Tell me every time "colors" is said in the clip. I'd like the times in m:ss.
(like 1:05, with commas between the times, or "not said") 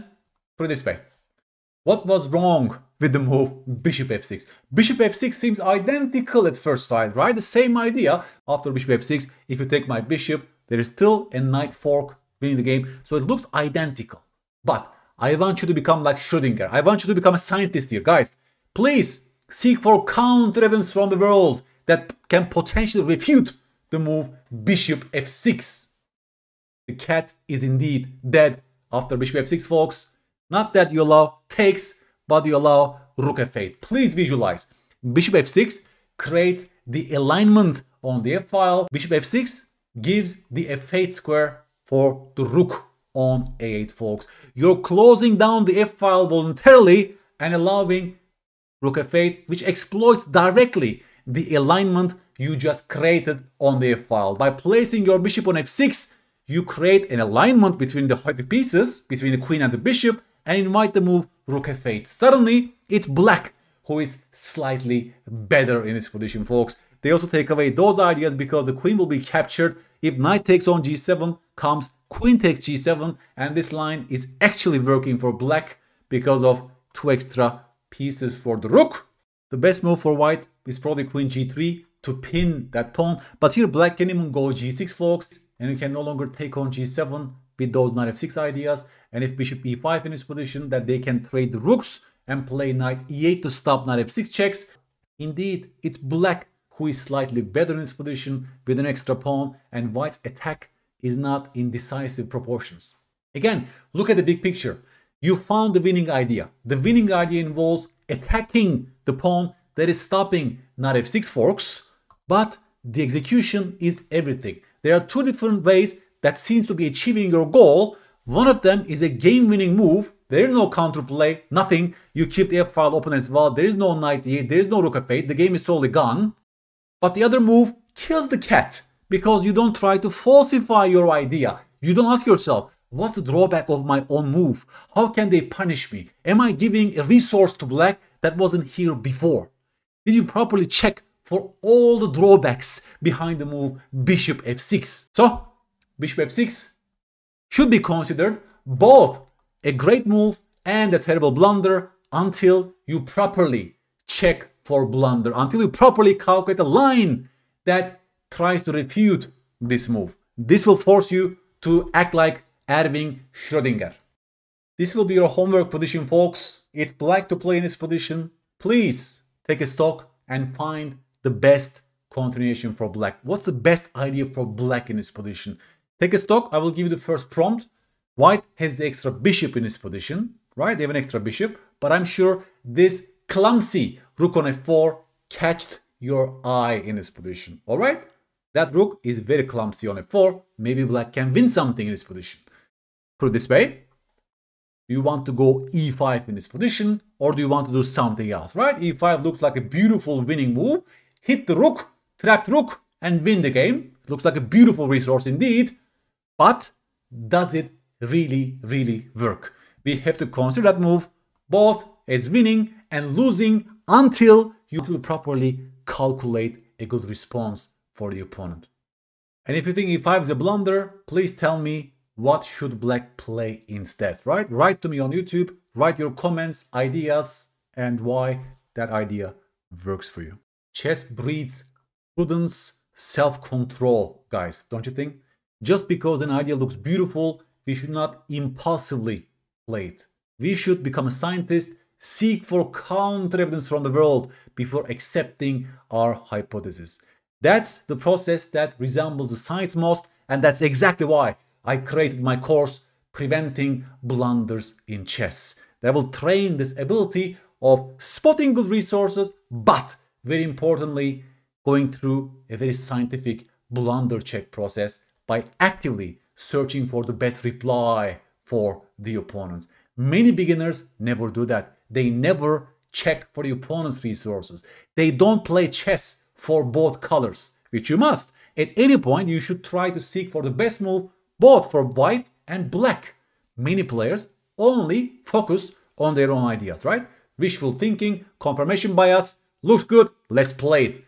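4:37.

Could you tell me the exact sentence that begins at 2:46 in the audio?
If black to play in this position, please take a stock and find the best continuation for black.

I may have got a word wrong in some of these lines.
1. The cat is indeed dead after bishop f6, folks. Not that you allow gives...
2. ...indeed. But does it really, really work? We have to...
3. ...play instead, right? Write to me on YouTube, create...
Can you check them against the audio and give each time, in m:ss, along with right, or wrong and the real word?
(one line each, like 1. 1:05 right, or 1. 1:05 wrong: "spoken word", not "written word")
1. 0:26 wrong: "takes", not "gives"
2. 3:25 right
3. 3:43 wrong: "write", not "create".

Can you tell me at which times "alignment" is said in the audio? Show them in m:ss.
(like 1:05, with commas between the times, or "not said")
0:37, 0:51, 0:57.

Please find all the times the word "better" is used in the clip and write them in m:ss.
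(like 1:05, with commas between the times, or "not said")
1:05, 1:37.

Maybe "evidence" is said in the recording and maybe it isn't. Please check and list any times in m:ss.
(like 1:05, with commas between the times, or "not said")
0:20, 4:03.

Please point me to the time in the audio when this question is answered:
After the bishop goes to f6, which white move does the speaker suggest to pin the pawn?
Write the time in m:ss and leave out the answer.
1:21.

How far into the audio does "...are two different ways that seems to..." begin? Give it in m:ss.
1:54.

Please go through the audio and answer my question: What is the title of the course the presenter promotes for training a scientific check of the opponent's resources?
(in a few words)
Preventing Blunders in Chess.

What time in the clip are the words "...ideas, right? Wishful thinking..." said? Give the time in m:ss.
4:46.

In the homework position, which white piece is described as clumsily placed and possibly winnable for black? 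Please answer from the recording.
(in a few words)
Rook on f4.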